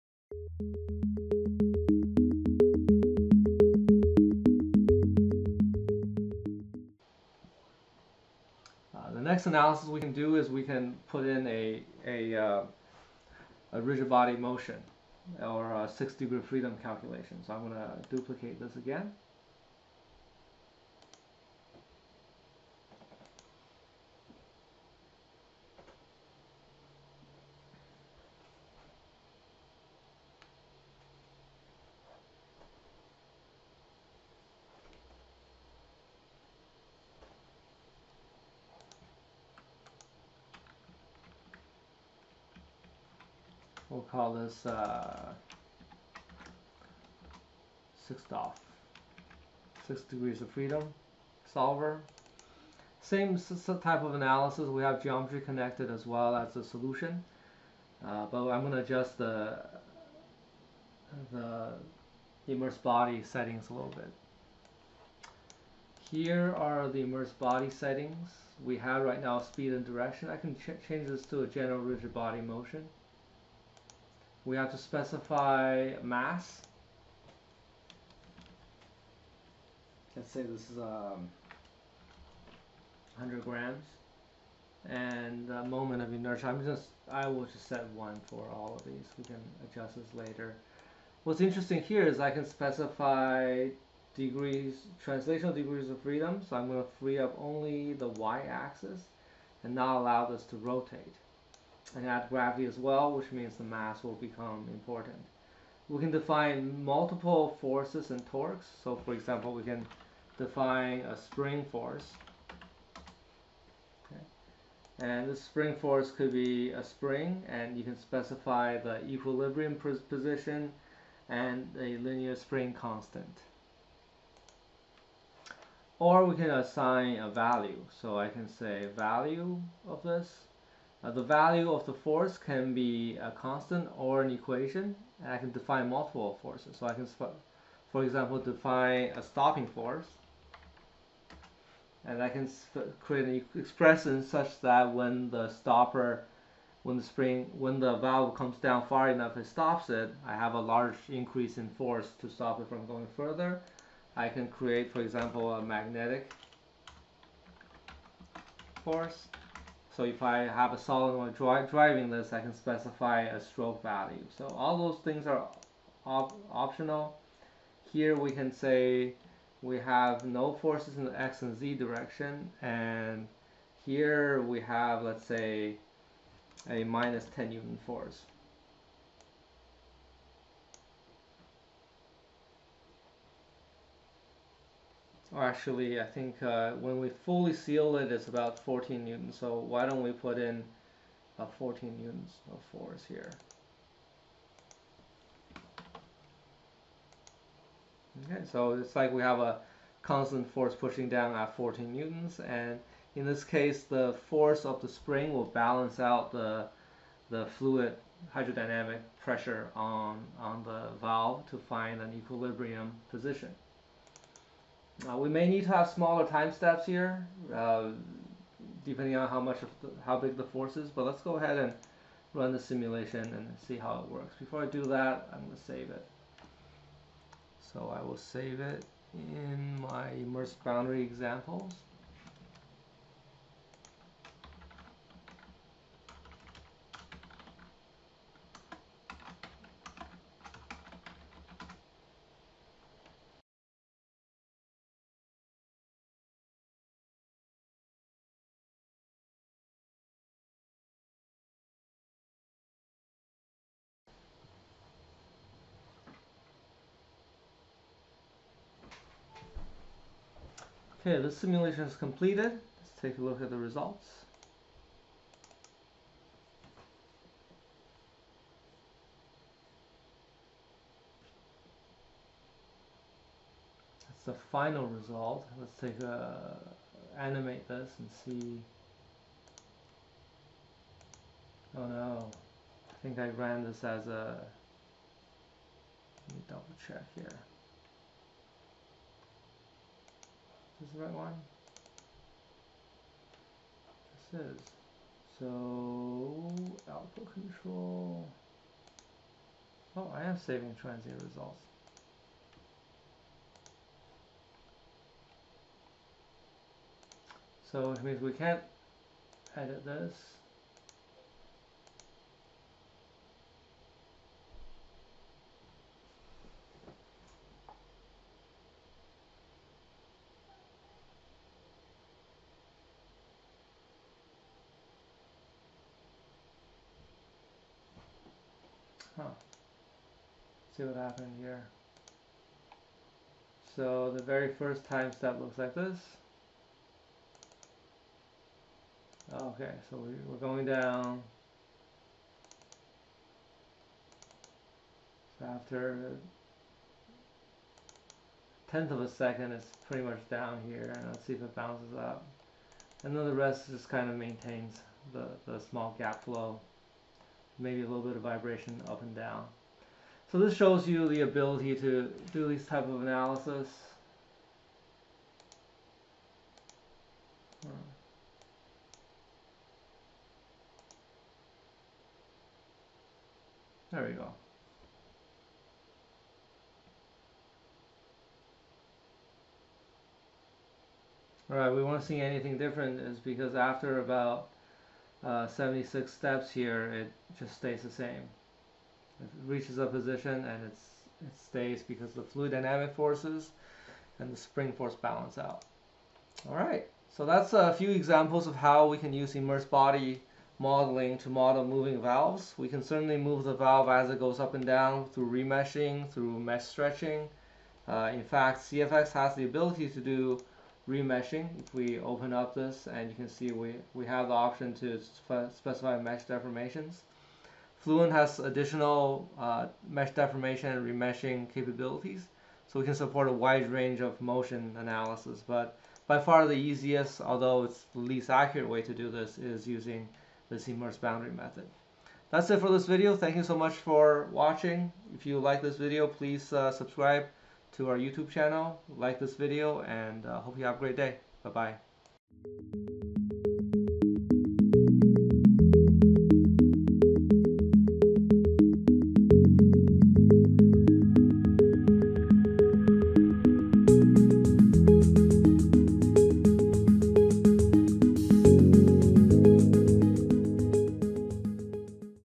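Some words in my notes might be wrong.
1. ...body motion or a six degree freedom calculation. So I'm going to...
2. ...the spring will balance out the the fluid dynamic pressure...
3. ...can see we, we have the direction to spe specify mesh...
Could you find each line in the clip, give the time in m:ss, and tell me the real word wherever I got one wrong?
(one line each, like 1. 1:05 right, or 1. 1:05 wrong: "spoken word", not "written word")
1. 0:14 right
2. 3:24 wrong: "hydrodynamic", not "dynamic"
3. 6:53 wrong: "option", not "direction".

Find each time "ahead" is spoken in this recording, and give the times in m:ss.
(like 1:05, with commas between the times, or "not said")
3:41.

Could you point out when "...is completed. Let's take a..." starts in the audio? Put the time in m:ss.
4:21.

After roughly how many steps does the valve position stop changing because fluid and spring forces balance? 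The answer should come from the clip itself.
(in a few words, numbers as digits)
76.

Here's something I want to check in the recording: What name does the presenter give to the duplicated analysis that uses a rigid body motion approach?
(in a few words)
6DOF.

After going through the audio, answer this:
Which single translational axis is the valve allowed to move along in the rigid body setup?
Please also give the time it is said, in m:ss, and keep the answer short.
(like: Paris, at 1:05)
y-axis, at 1:38.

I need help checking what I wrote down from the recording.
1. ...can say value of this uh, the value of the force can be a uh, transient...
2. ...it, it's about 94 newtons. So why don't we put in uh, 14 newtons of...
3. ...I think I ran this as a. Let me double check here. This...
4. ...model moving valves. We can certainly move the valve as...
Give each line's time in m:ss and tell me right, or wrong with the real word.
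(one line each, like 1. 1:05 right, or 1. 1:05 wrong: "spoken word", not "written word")
1. 2:08 wrong: "constant", not "transient"
2. 3:07 wrong: "14", not "94"
3. 4:42 right
4. 6:41 right.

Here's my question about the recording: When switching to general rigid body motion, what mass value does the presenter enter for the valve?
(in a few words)
100 grams.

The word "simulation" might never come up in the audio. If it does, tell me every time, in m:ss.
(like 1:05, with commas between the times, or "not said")
3:42, 4:21.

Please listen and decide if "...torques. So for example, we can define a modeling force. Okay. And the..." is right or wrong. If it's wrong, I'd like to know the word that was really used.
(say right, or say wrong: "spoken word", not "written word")
wrong: "spring", not "modeling".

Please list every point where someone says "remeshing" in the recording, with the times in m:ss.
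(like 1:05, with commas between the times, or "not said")
6:45, 6:50, 7:00.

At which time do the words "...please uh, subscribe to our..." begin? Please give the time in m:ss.
7:16.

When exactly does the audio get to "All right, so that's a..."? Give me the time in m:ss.
6:36.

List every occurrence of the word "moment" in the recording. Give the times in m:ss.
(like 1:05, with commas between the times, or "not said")
1:25.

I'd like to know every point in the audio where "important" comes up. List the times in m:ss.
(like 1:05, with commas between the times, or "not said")
1:44.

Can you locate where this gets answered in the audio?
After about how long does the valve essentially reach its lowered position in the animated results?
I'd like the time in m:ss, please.
5:48.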